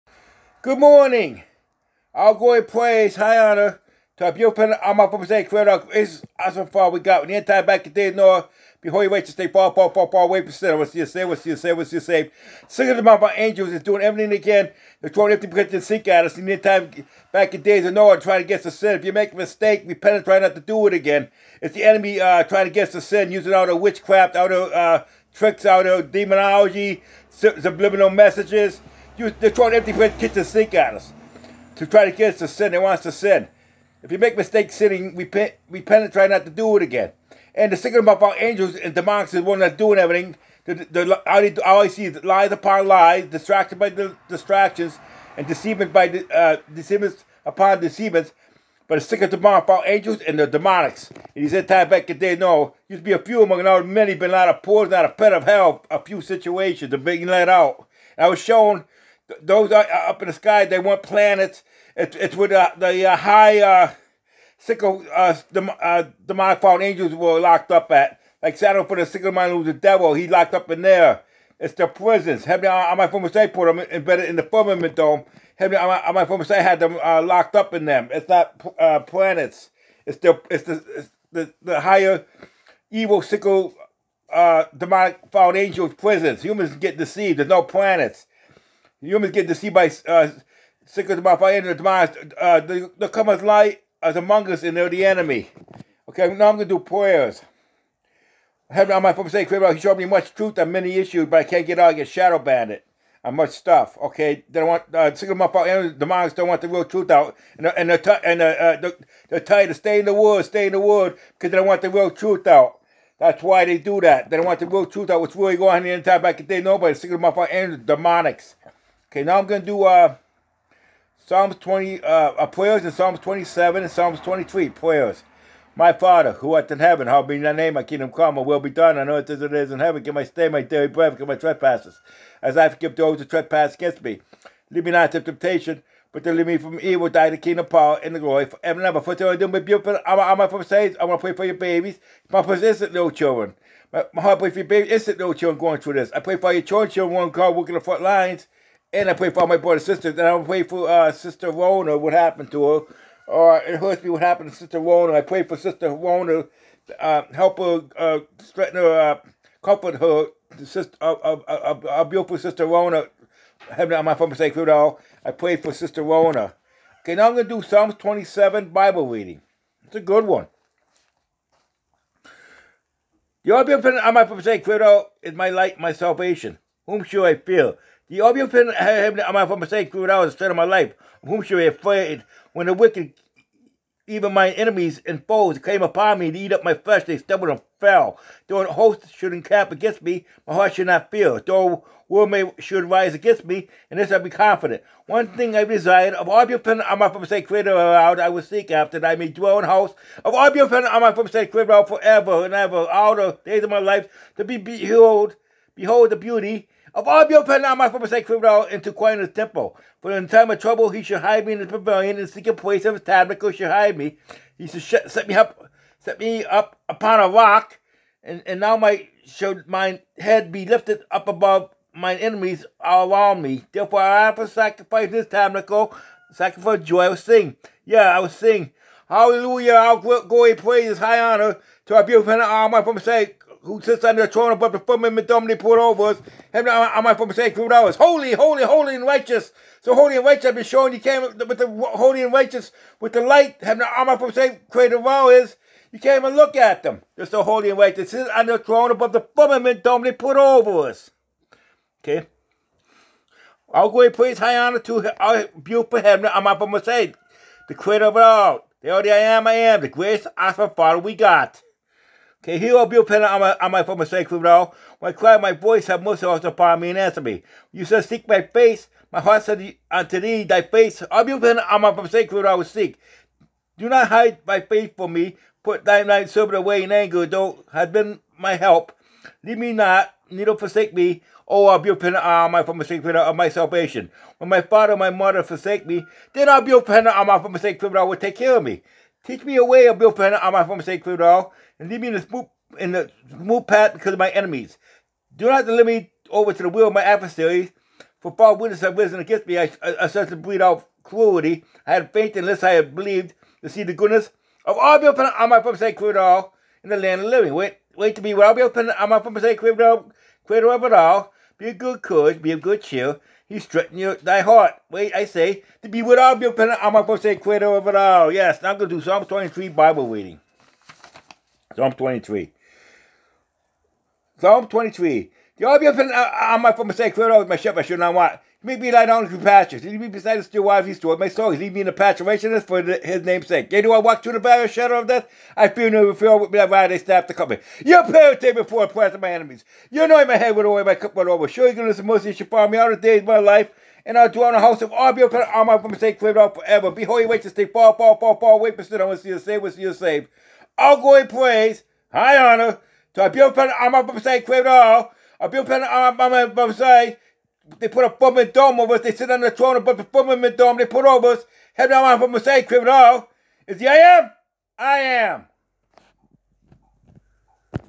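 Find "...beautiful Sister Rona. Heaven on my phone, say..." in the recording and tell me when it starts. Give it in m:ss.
2:42.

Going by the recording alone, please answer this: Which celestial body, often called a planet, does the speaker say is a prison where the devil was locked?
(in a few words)
Saturn.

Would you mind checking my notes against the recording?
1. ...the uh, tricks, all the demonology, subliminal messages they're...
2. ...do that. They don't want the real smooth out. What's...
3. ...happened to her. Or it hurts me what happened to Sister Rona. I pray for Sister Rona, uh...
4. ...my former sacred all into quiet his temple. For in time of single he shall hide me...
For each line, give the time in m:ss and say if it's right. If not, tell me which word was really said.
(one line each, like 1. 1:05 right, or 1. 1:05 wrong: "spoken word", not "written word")
1. 0:24 right
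2. 1:53 wrong: "truth", not "smooth"
3. 2:32 right
4. 3:27 wrong: "trouble", not "single".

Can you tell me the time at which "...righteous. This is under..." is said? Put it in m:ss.
4:07.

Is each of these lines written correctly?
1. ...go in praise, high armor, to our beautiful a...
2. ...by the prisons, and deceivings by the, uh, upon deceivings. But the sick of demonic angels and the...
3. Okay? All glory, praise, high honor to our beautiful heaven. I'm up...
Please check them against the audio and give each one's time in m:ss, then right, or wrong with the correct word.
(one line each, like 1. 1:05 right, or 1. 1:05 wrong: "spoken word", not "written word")
1. 0:02 wrong: "honor", not "armor"
2. 0:43 wrong: "distractions", not "prisons"
3. 4:12 right.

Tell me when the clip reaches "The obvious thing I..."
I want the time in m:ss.
2:58.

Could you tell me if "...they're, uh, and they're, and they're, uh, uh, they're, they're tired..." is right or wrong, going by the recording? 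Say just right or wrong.
right.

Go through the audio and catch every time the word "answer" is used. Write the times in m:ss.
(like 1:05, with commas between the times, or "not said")
4:26.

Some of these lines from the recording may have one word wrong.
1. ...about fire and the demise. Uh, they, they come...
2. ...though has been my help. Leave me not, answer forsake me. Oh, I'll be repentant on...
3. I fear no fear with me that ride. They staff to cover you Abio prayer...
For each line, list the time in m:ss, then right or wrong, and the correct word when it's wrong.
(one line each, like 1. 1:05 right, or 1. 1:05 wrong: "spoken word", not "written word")
1. 1:31 right
2. 4:37 wrong: "neither", not "answer"
3. 5:35 wrong: "Your", not "Abio".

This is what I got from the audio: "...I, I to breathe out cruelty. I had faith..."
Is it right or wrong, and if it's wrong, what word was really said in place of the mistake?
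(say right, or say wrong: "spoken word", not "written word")
right.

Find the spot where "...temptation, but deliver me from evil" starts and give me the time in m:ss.
2:15.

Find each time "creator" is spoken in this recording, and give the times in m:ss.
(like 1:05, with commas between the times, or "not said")
0:05, 3:17, 3:21, 4:04, 4:17, 5:09, 5:17.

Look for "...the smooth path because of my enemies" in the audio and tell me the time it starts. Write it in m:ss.
4:52.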